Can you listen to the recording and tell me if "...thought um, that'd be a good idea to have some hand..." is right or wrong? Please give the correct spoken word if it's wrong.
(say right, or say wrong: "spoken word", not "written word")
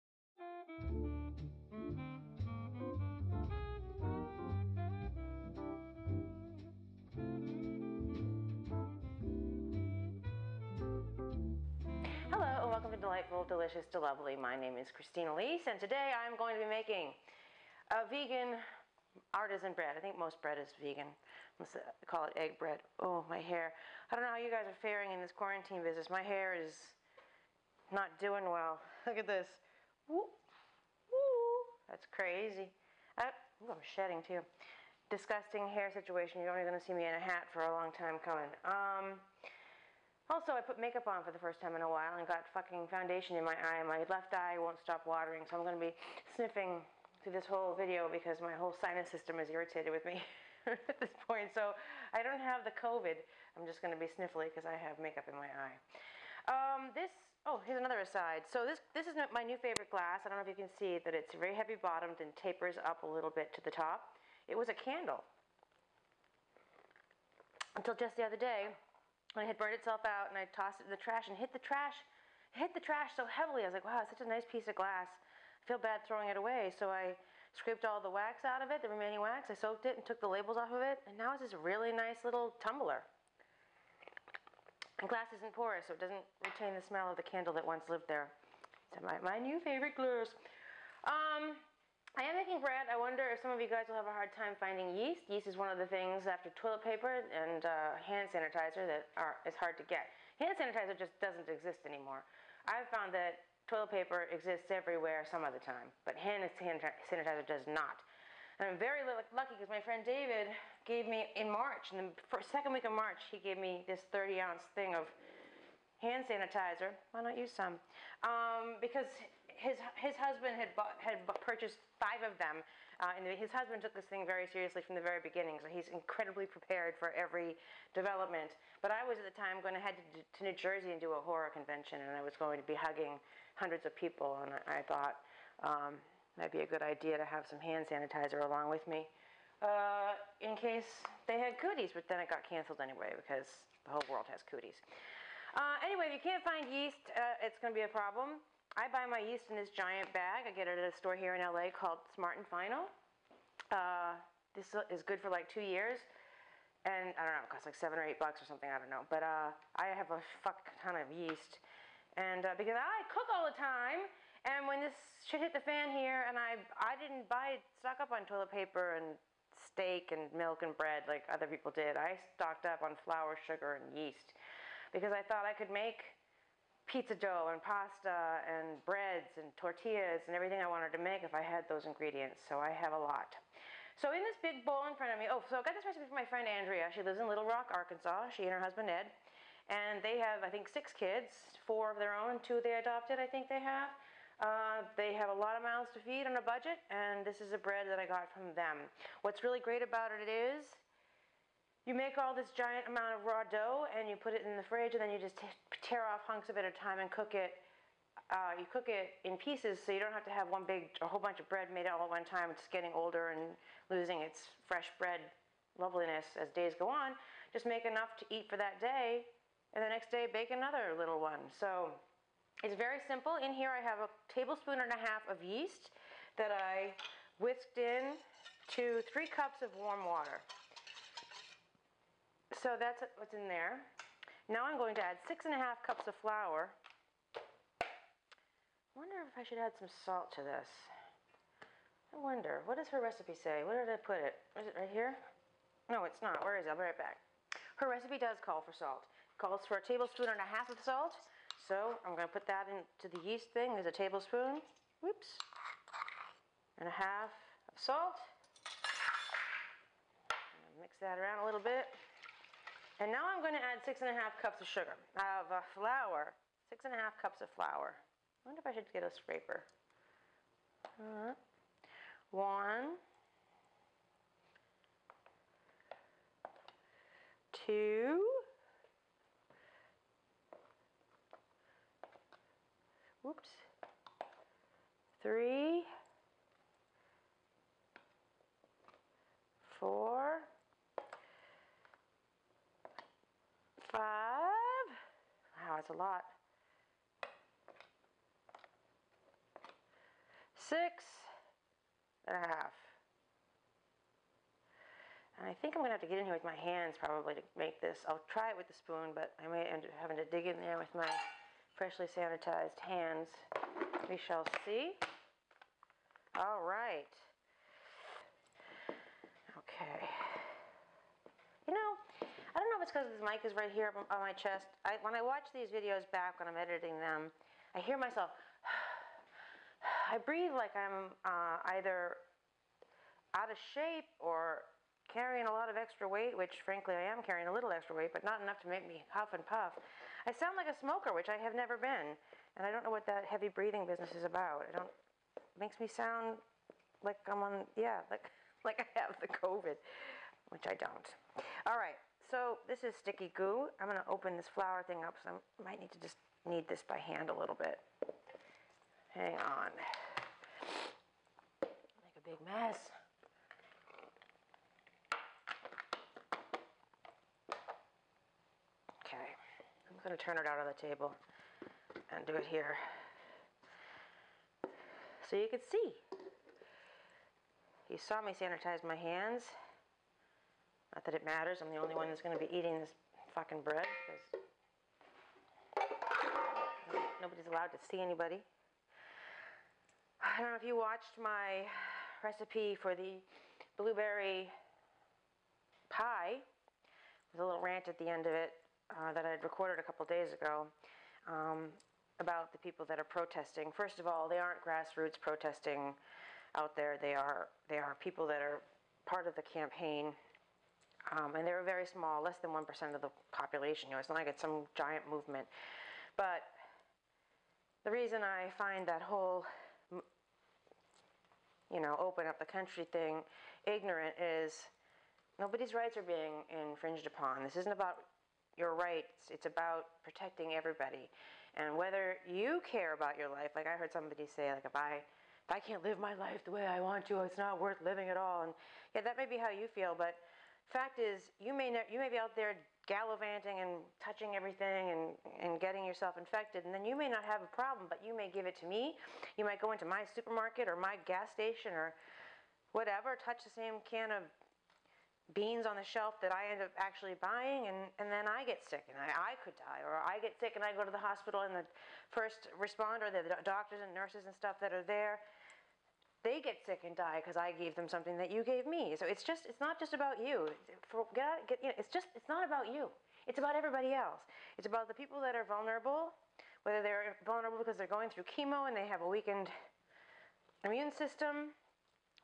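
right.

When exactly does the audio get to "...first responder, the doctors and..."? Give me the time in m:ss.
7:42.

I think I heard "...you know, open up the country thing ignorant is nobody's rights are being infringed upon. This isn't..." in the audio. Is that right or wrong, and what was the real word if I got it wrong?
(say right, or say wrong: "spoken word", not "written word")
right.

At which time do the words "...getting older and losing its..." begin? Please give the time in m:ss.
3:32.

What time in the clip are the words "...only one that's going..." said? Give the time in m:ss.
6:21.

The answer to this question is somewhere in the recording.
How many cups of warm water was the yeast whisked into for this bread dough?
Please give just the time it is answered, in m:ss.
3:49.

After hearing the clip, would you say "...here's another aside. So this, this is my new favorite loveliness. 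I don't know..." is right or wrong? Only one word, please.
wrong.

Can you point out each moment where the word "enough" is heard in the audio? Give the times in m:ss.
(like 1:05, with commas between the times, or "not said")
3:37, 5:38.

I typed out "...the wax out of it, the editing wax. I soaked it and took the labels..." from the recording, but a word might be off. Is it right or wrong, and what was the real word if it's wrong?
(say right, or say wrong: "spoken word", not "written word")
wrong: "remaining", not "editing".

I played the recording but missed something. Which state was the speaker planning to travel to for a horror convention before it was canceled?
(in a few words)
New Jersey.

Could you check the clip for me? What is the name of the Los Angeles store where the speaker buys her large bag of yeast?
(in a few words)
Smart and Final.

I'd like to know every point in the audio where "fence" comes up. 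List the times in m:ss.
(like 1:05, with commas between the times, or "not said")
not said.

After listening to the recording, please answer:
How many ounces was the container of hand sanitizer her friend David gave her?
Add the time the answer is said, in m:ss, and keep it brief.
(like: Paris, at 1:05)
30, at 1:54.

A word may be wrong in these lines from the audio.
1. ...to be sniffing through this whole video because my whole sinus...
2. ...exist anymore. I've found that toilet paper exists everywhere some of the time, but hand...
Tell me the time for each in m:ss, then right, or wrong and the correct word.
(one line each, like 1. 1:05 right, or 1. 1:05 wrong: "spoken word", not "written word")
1. 0:45 right
2. 1:41 right.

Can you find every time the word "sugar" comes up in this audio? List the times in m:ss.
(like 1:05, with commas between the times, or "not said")
2:53, 4:24.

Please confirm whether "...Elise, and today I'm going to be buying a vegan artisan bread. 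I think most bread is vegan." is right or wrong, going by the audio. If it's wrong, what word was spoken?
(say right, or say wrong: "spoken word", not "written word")
wrong: "making", not "buying".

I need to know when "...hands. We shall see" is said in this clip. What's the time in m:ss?
5:12.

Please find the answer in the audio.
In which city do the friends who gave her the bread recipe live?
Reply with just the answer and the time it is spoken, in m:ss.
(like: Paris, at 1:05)
Little Rock, at 3:07.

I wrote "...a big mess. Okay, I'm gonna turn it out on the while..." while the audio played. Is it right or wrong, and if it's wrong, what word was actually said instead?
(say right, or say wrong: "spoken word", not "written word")
wrong: "table", not "while".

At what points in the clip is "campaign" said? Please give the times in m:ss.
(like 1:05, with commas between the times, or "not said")
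6:49.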